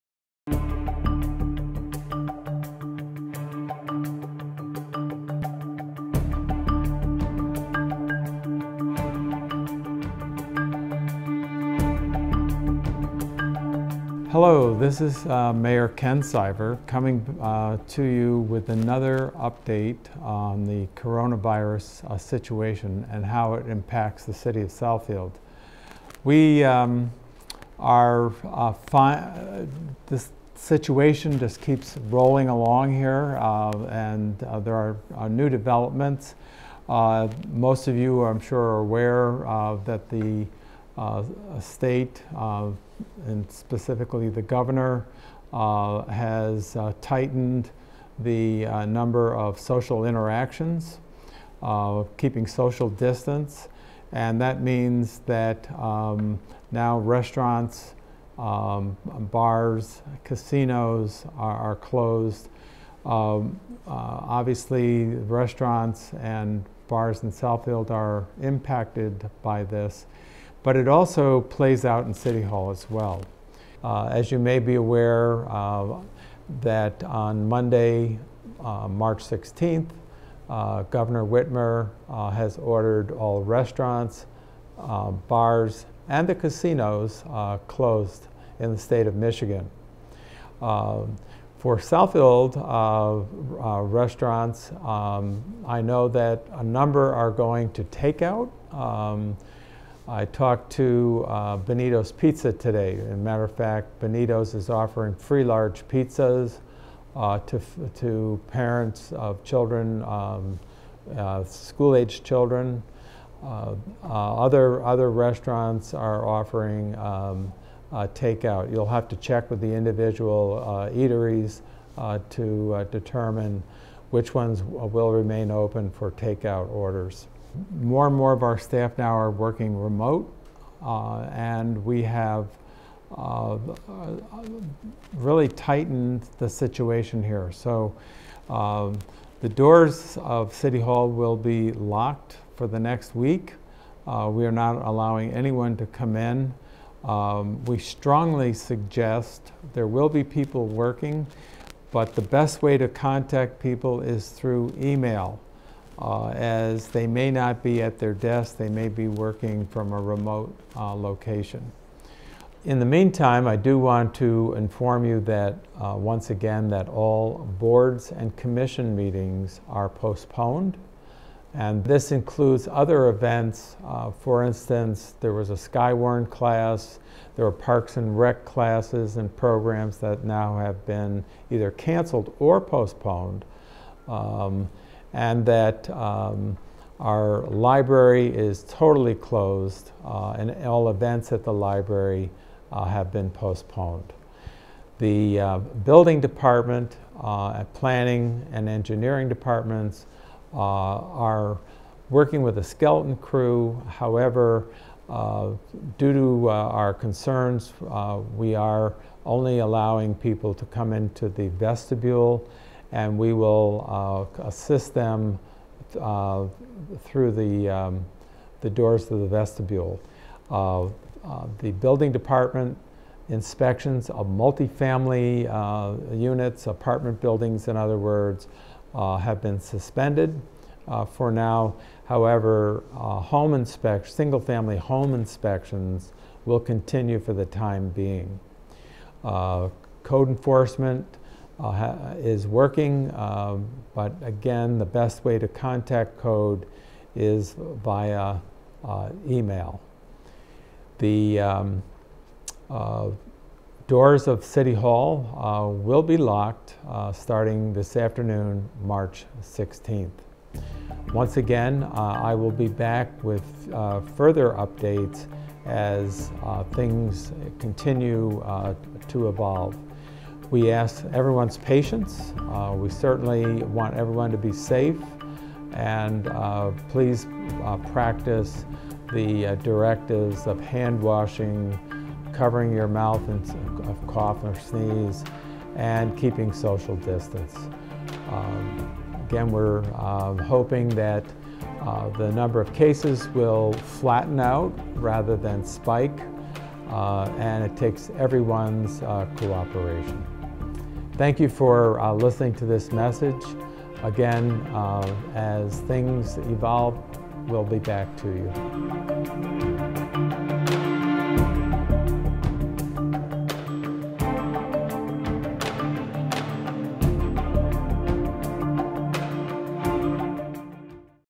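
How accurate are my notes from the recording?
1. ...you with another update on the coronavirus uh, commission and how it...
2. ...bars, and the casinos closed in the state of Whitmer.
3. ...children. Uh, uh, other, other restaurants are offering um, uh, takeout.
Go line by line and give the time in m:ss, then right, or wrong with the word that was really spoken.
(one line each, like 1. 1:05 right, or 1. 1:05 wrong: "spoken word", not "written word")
1. 0:18 wrong: "situation", not "commission"
2. 1:25 wrong: "Michigan", not "Whitmer"
3. 1:52 right.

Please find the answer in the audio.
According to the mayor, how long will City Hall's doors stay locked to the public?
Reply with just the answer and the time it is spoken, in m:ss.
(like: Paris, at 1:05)
The next week, at 2:22.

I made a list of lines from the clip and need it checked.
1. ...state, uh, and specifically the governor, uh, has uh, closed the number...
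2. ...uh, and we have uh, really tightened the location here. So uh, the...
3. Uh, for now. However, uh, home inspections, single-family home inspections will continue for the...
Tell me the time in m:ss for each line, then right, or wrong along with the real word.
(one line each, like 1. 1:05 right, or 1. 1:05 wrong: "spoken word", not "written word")
1. 0:41 wrong: "tightened", not "closed"
2. 2:10 wrong: "situation", not "location"
3. 3:50 right.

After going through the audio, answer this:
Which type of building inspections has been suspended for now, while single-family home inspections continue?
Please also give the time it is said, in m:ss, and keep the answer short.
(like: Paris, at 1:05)
Multifamily units, at 3:44.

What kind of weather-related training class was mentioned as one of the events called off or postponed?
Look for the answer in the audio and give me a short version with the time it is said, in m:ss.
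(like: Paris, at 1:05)
Skywarn class, at 2:55.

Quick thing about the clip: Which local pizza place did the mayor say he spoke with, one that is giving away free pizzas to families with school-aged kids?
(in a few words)
Benito's Pizza.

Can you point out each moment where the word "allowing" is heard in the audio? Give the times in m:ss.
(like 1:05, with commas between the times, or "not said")
2:24, 3:29.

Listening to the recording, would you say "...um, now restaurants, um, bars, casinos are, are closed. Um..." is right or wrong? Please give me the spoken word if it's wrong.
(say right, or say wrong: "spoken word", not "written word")
right.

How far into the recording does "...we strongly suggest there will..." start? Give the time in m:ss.
2:27.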